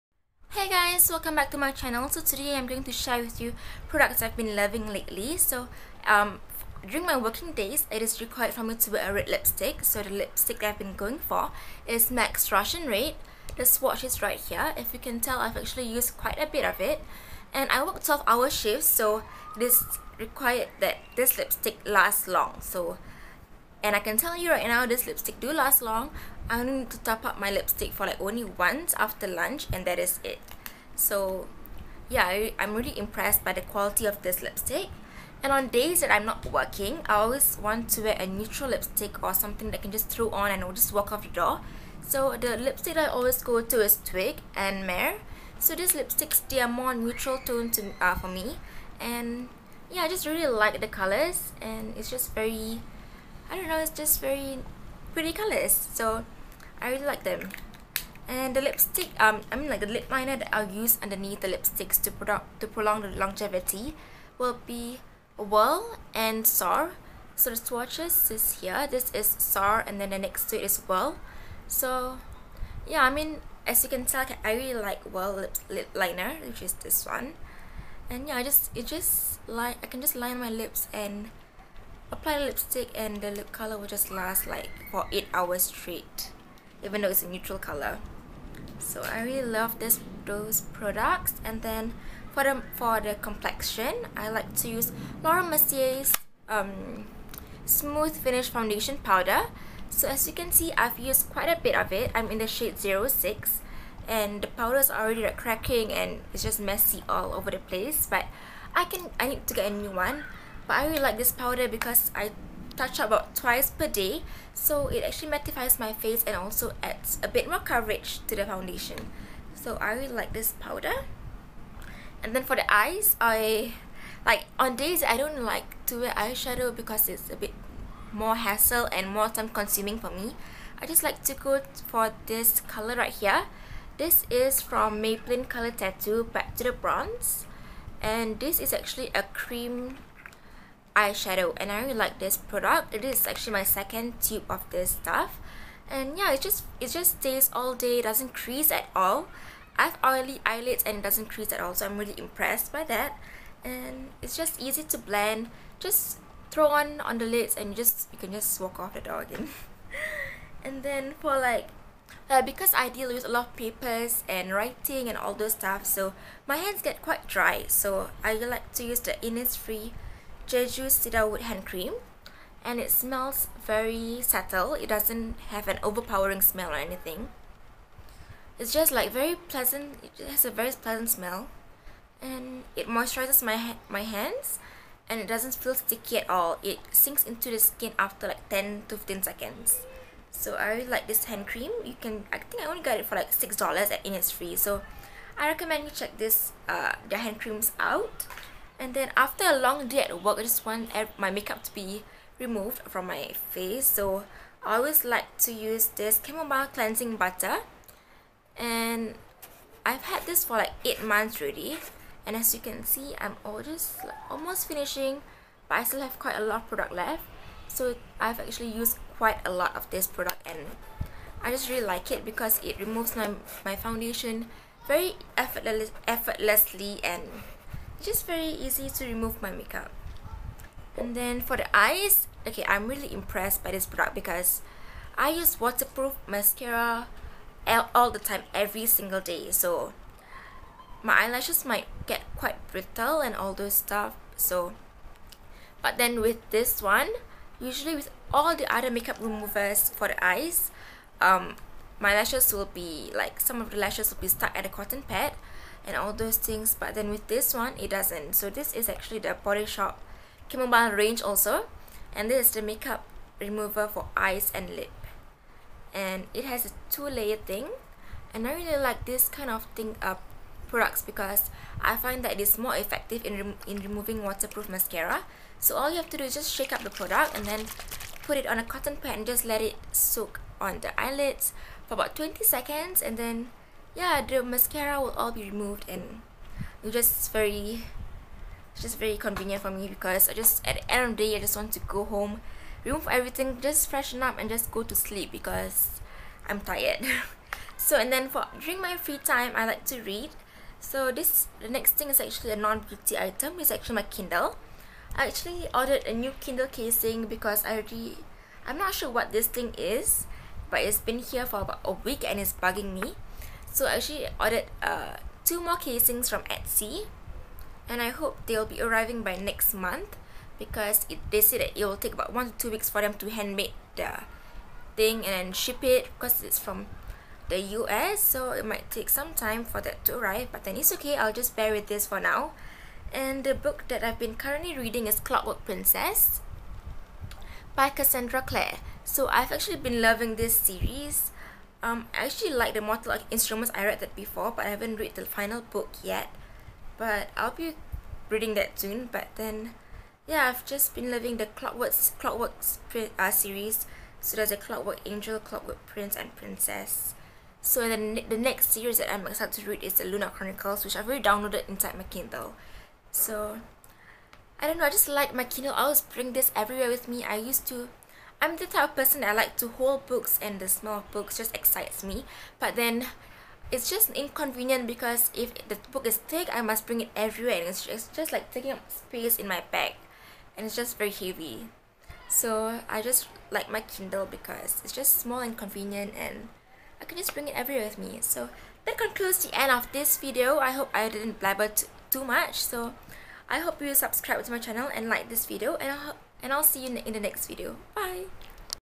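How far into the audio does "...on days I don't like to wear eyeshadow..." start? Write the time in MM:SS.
02:04.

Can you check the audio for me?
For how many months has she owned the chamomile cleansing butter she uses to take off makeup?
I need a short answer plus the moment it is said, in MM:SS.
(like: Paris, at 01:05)
8 months, at 03:30.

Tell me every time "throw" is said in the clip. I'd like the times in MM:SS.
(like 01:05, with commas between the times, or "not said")
00:40, 02:36.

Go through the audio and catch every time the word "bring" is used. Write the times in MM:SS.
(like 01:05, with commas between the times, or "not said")
06:06, 06:16, 06:27.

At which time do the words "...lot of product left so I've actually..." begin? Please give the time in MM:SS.
03:36.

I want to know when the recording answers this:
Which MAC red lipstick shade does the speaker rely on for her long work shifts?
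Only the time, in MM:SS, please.
00:12.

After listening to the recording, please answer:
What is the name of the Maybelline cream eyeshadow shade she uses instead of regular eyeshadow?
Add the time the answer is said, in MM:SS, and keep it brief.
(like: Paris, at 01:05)
Bad to the Bronze, at 02:16.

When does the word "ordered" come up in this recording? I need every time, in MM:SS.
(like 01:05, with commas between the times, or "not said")
05:05, 05:14.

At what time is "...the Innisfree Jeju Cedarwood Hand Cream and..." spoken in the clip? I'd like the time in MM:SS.
02:48.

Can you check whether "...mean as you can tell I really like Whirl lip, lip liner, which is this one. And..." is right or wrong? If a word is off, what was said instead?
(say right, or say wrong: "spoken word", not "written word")
right.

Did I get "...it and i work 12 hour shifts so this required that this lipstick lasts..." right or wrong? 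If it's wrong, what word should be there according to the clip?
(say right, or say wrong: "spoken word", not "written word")
right.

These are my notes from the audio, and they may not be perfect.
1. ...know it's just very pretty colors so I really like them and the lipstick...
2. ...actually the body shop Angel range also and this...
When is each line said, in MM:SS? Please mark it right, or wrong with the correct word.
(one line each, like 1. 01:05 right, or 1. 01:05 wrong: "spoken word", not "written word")
1. 00:53 right
2. 04:18 wrong: "Camomile", not "Angel".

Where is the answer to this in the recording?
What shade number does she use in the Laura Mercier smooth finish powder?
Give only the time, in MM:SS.
01:42.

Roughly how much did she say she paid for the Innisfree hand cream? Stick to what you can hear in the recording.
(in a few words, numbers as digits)
$6.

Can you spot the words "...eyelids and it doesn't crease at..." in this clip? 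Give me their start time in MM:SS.
02:30.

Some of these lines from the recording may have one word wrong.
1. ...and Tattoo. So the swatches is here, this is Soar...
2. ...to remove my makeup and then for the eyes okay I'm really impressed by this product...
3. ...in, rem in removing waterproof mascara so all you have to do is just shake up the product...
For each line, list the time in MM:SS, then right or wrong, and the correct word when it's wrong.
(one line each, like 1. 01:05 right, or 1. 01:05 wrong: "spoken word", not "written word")
1. 01:06 wrong: "Soar", not "Tattoo"
2. 03:48 right
3. 04:33 right.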